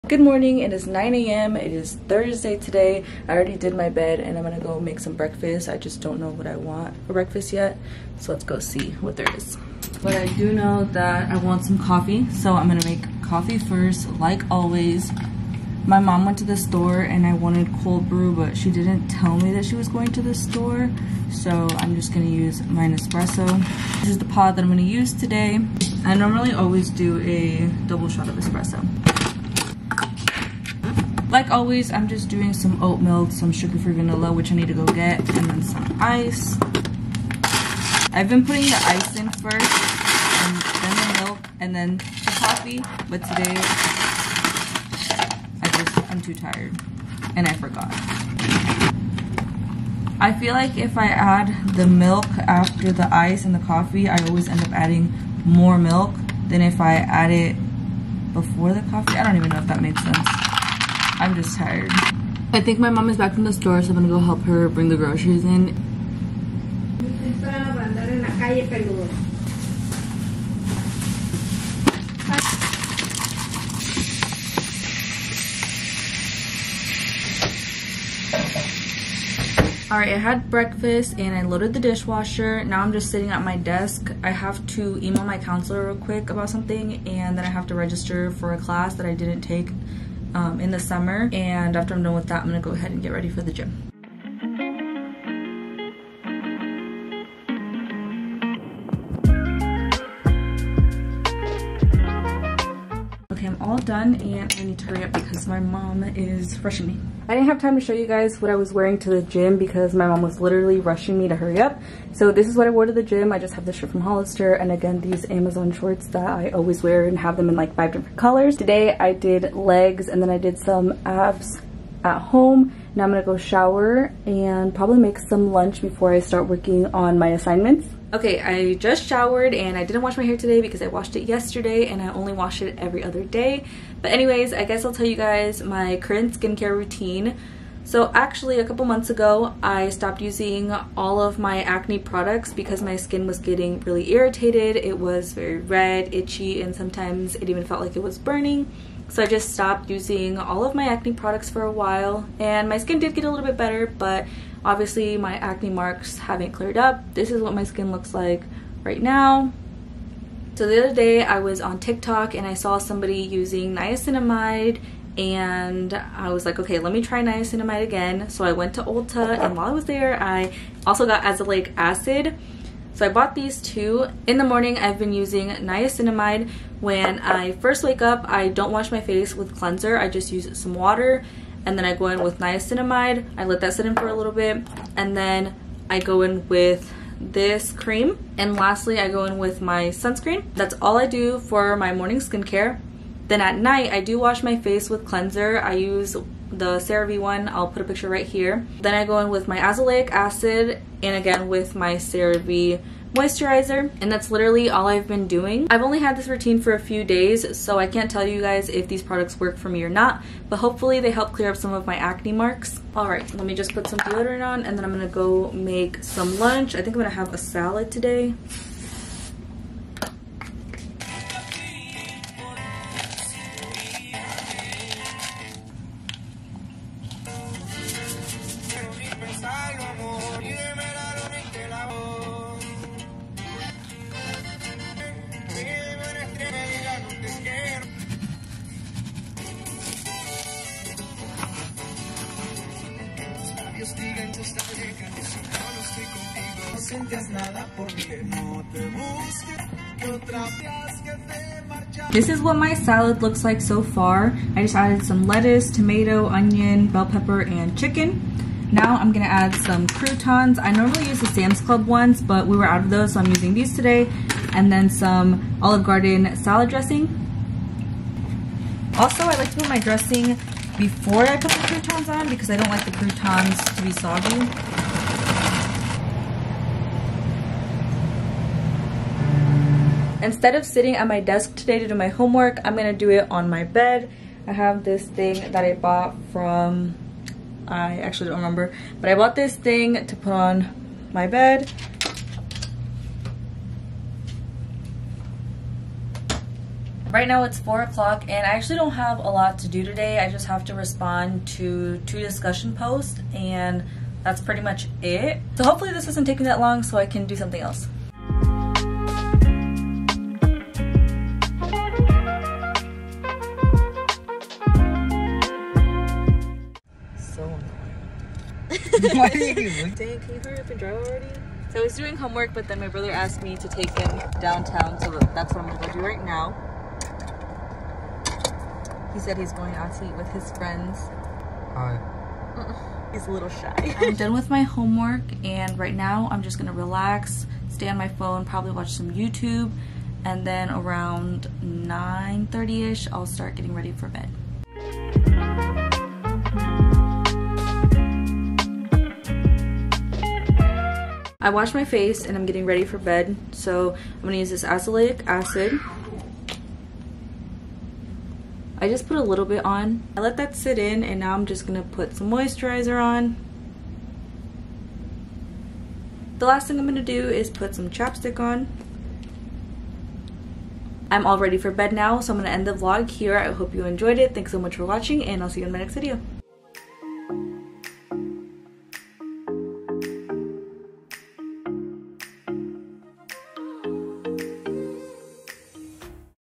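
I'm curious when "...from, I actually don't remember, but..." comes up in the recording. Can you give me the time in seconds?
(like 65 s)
286 s.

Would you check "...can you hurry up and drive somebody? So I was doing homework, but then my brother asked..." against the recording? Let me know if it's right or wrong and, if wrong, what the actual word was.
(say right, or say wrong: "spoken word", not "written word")
wrong: "already", not "somebody".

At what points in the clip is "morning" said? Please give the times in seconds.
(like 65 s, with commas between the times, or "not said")
0 s, 174 s, 191 s.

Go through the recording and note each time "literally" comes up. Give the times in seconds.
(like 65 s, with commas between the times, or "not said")
110 s, 204 s.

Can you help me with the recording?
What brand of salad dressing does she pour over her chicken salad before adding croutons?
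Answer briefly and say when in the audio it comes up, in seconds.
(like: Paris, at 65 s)
Olive Garden, at 265 s.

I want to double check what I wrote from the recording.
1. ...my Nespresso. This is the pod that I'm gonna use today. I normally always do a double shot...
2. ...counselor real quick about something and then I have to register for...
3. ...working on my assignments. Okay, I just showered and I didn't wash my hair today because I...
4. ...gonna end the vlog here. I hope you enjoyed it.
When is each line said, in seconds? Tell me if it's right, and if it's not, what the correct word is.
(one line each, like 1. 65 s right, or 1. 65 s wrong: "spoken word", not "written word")
1. 22 s right
2. 85 s right
3. 126 s right
4. 372 s right.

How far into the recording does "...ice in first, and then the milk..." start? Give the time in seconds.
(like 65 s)
38 s.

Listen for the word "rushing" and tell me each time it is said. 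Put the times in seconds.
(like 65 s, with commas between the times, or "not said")
106 s, 110 s.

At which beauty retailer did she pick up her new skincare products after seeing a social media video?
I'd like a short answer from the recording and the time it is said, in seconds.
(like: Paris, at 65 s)
Ulta, at 168 s.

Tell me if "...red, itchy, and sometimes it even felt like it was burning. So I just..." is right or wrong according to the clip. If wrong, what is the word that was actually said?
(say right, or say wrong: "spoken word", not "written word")
right.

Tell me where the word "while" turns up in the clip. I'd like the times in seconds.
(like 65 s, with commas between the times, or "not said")
151 s, 169 s.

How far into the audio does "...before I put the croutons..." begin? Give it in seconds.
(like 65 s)
270 s.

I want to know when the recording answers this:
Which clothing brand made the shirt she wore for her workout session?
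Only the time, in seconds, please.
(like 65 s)
114 s.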